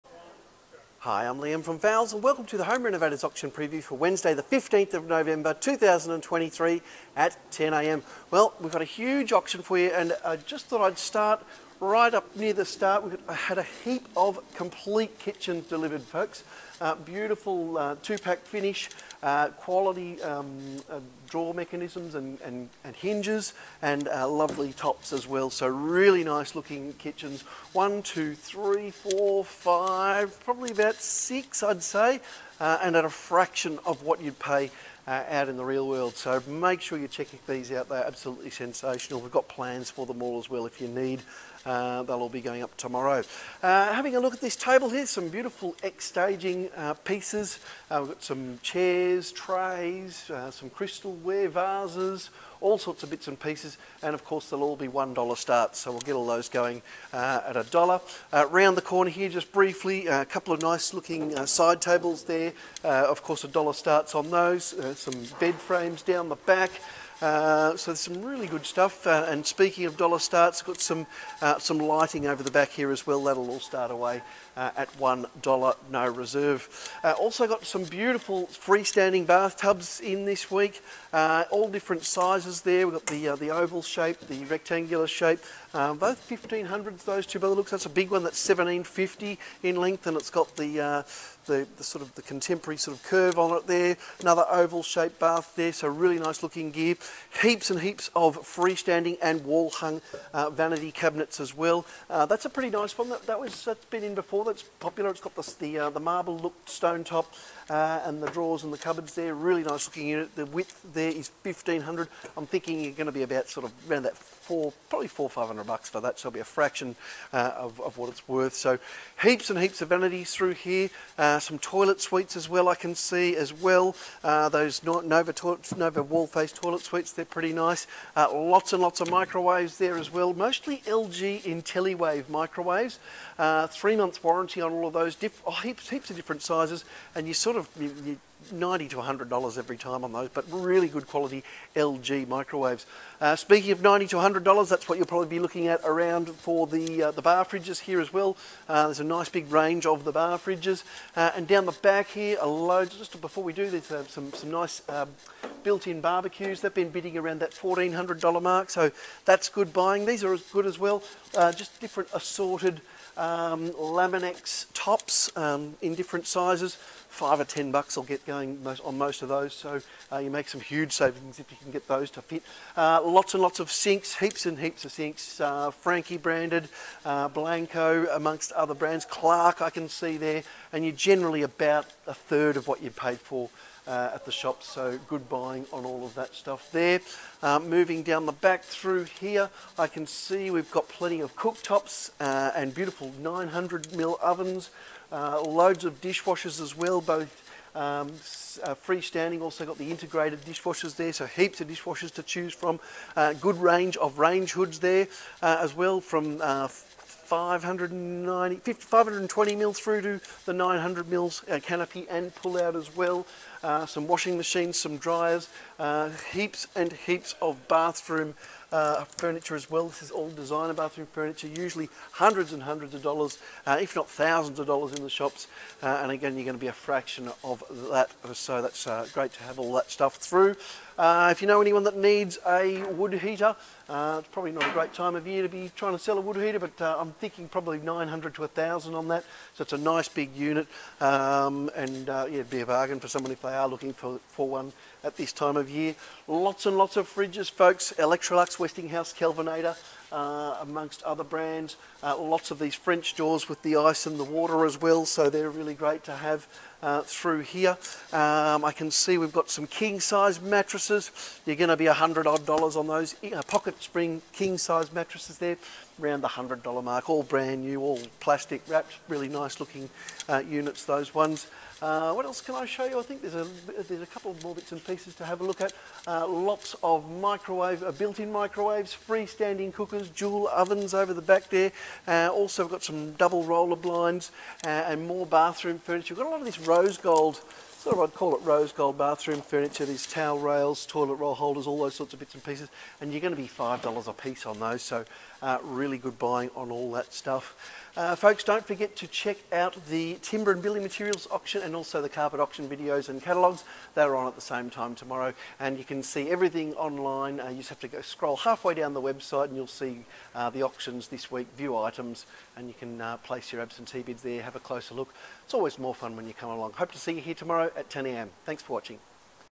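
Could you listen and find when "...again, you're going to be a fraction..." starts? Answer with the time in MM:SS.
03:46.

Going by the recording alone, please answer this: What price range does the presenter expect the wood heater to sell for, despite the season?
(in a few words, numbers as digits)
900 to 1,000.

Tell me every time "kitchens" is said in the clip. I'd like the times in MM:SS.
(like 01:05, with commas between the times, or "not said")
00:15, 00:26.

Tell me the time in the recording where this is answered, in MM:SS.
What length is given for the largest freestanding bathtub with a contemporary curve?
01:28.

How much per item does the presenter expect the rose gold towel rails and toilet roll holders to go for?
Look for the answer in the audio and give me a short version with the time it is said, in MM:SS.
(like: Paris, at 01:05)
$5, at 04:53.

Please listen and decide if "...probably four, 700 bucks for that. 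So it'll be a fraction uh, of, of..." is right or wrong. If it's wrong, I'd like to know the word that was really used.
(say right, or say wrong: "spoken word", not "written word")
wrong: "500", not "700".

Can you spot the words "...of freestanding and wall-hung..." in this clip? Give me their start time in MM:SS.
01:38.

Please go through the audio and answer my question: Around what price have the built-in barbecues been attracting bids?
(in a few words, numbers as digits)
$1,400.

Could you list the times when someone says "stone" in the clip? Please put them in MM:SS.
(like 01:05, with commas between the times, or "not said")
01:46.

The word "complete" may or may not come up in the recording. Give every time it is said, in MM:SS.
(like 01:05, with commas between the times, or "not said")
00:14.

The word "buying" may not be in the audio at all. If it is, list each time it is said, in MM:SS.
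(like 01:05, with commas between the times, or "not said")
02:39, 03:05, 04:56.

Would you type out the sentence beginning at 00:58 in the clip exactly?
round the corner here, just briefly, a couple of nice looking side tables there.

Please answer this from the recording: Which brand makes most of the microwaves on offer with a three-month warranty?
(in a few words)
LG IntelliWave.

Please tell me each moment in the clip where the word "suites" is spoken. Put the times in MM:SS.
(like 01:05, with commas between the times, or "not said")
02:02, 02:06.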